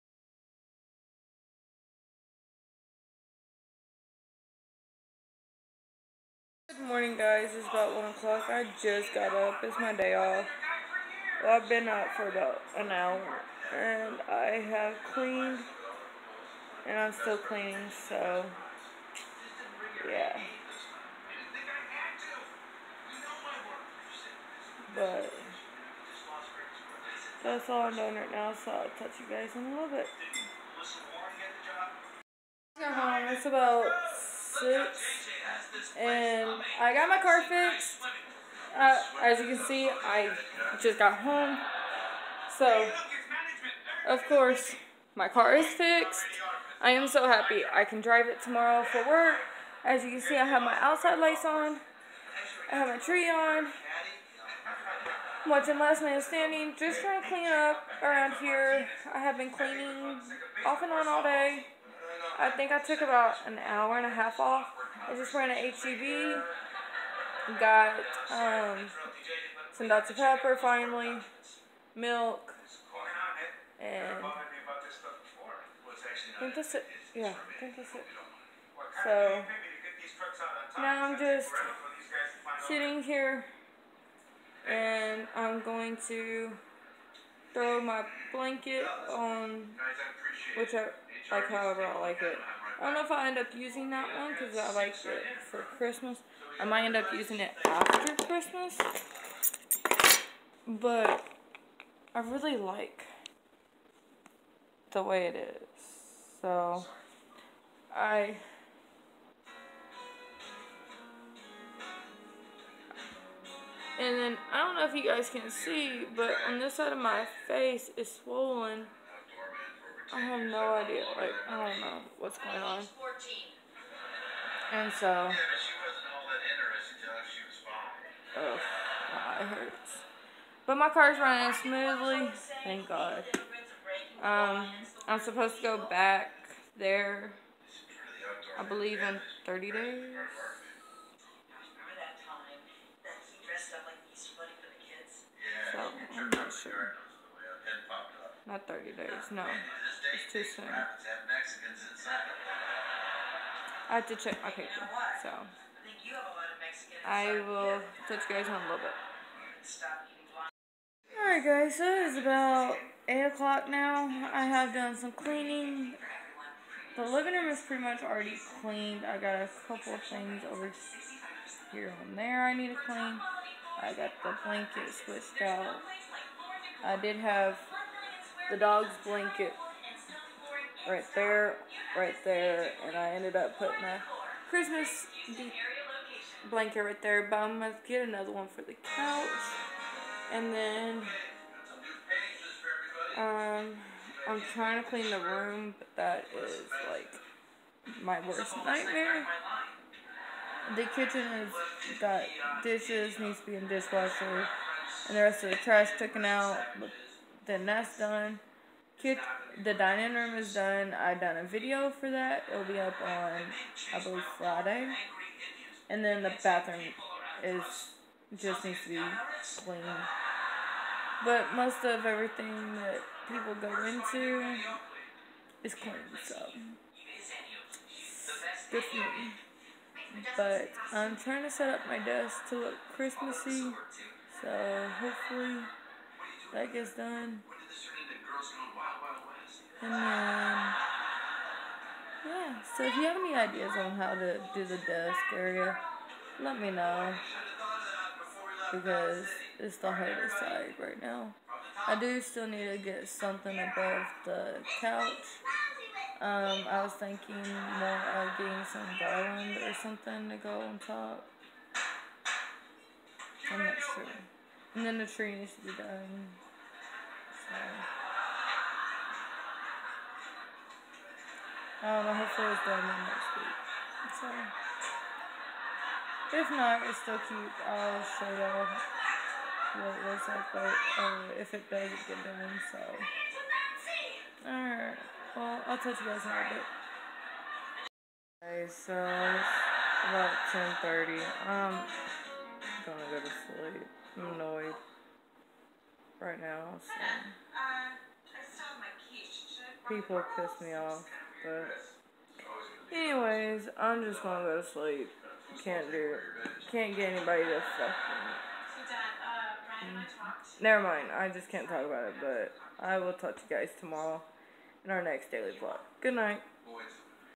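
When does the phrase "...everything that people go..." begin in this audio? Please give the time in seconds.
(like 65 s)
222 s.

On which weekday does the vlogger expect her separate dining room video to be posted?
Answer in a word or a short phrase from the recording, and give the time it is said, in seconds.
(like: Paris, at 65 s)
Friday, at 214 s.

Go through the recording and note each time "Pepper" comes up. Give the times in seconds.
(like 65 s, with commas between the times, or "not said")
70 s.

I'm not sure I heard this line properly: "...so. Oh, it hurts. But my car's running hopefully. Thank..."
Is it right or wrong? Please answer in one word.
wrong.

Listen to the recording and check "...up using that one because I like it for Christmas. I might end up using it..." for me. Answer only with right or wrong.
right.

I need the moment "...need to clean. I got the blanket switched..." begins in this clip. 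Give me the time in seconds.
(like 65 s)
172 s.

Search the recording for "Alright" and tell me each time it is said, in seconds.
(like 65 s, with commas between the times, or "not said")
161 s, 284 s.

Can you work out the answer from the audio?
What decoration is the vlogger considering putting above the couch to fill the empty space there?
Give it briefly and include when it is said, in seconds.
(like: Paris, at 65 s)
garland, at 258 s.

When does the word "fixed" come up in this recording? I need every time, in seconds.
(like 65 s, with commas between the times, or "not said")
37 s, 45 s.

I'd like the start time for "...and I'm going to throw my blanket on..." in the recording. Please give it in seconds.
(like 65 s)
84 s.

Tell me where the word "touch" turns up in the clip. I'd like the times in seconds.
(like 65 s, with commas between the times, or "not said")
28 s, 158 s, 285 s.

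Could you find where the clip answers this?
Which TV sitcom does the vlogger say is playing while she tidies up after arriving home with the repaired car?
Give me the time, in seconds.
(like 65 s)
55 s.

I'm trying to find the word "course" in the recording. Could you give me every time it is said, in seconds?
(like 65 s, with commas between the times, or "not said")
44 s.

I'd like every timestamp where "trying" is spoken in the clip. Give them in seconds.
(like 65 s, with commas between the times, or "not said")
57 s, 194 s, 231 s.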